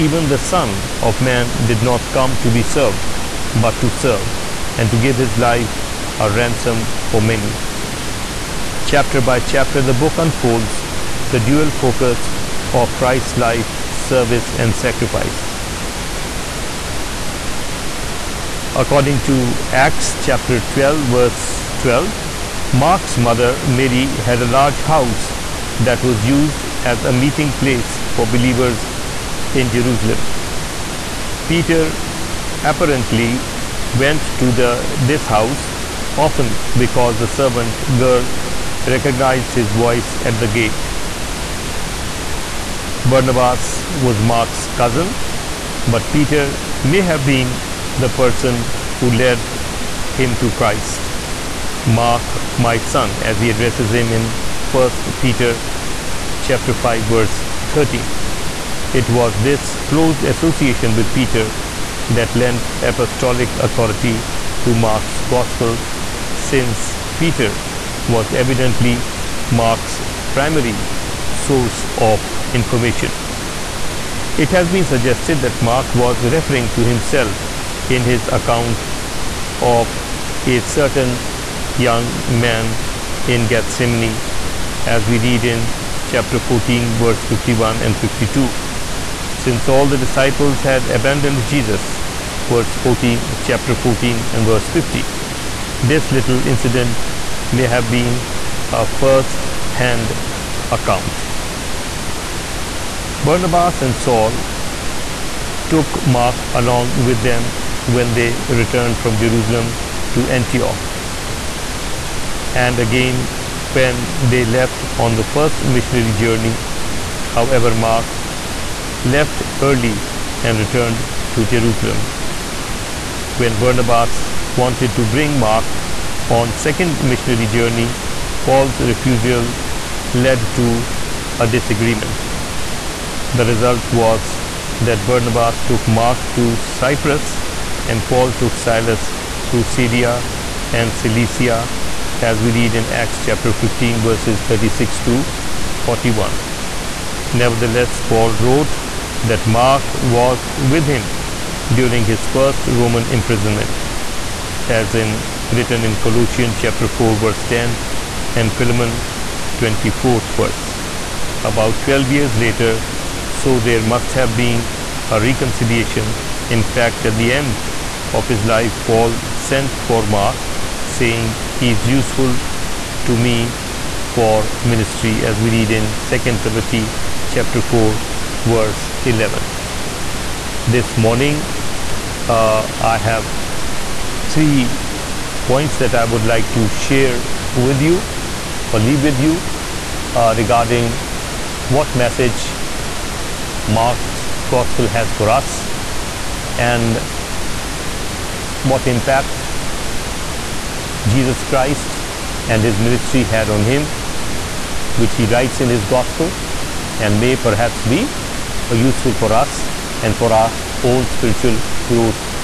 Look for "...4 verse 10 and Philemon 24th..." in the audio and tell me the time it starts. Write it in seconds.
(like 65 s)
156 s.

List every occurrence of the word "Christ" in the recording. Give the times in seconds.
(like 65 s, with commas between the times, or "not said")
12 s, 50 s, 201 s.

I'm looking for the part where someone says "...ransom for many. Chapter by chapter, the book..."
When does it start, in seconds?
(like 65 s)
6 s.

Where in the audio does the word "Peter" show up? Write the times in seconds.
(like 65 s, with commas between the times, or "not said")
31 s, 46 s, 55 s, 61 s, 67 s.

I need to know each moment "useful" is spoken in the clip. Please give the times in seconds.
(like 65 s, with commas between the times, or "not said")
171 s, 208 s.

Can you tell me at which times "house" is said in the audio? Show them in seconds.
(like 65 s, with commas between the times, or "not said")
24 s, 35 s.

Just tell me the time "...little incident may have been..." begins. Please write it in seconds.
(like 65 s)
96 s.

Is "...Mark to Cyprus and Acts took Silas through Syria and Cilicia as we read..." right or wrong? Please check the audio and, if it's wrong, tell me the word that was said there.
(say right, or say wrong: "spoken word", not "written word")
wrong: "Paul", not "Acts".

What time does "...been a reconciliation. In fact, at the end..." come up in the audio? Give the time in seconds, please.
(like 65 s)
164 s.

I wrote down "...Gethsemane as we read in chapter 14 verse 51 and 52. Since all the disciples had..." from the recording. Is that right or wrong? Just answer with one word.
right.